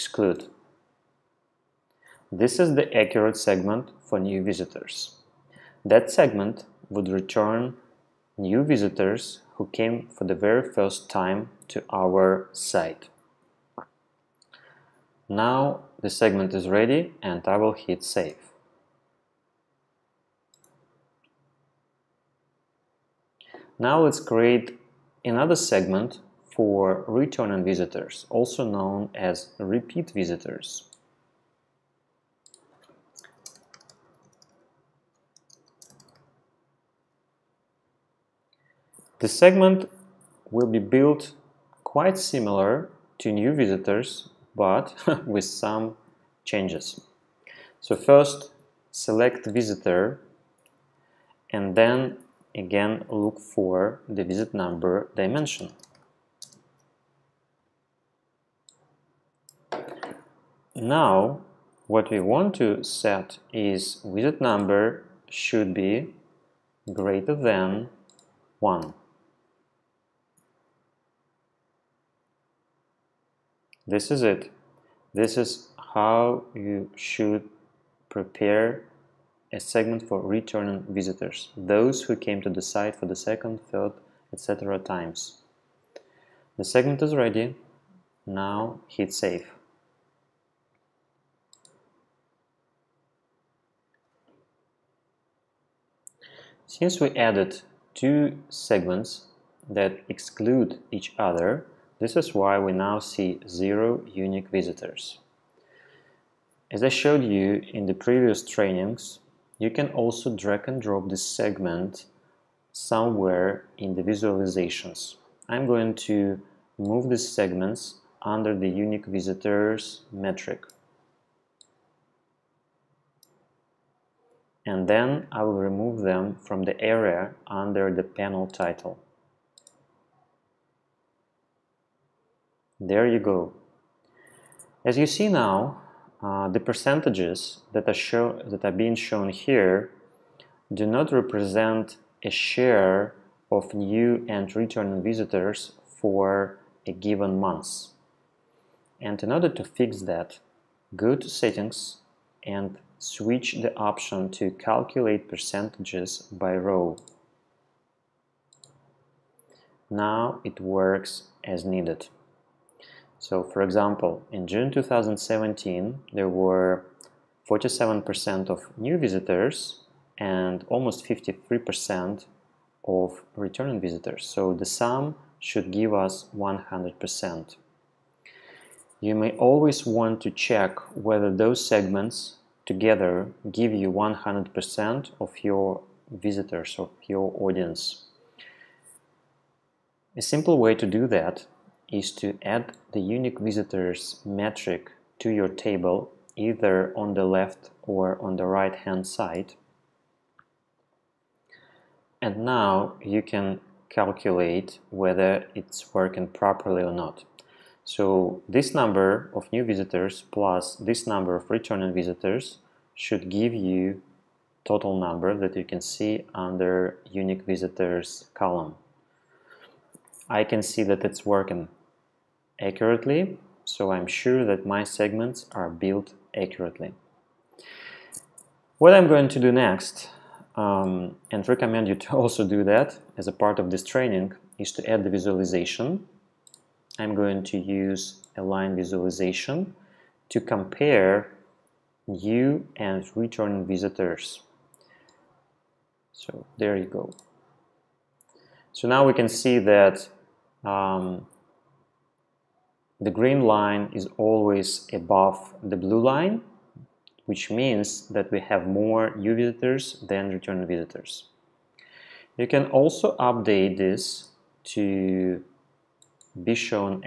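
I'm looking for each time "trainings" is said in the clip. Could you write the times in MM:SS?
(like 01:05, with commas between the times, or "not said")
01:48, 03:53.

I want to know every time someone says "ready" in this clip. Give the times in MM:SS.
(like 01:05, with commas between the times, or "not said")
00:16, 01:27.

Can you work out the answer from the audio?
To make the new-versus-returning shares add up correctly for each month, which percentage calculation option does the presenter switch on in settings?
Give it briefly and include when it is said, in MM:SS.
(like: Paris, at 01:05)
calculate percentages by row, at 02:34.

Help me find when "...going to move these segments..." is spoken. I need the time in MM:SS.
01:55.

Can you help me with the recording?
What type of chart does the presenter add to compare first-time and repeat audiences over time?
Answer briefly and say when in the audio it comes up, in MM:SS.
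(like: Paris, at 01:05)
line visualization, at 03:58.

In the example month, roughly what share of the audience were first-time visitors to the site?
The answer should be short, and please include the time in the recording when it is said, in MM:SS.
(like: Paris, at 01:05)
47%, at 02:47.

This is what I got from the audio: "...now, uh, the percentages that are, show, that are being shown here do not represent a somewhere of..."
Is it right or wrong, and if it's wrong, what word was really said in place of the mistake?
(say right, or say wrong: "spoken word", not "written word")
wrong: "share", not "somewhere".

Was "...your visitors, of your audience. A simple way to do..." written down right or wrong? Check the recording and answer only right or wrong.
right.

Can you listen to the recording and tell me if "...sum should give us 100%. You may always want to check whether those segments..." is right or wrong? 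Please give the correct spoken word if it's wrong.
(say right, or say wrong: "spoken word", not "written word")
right.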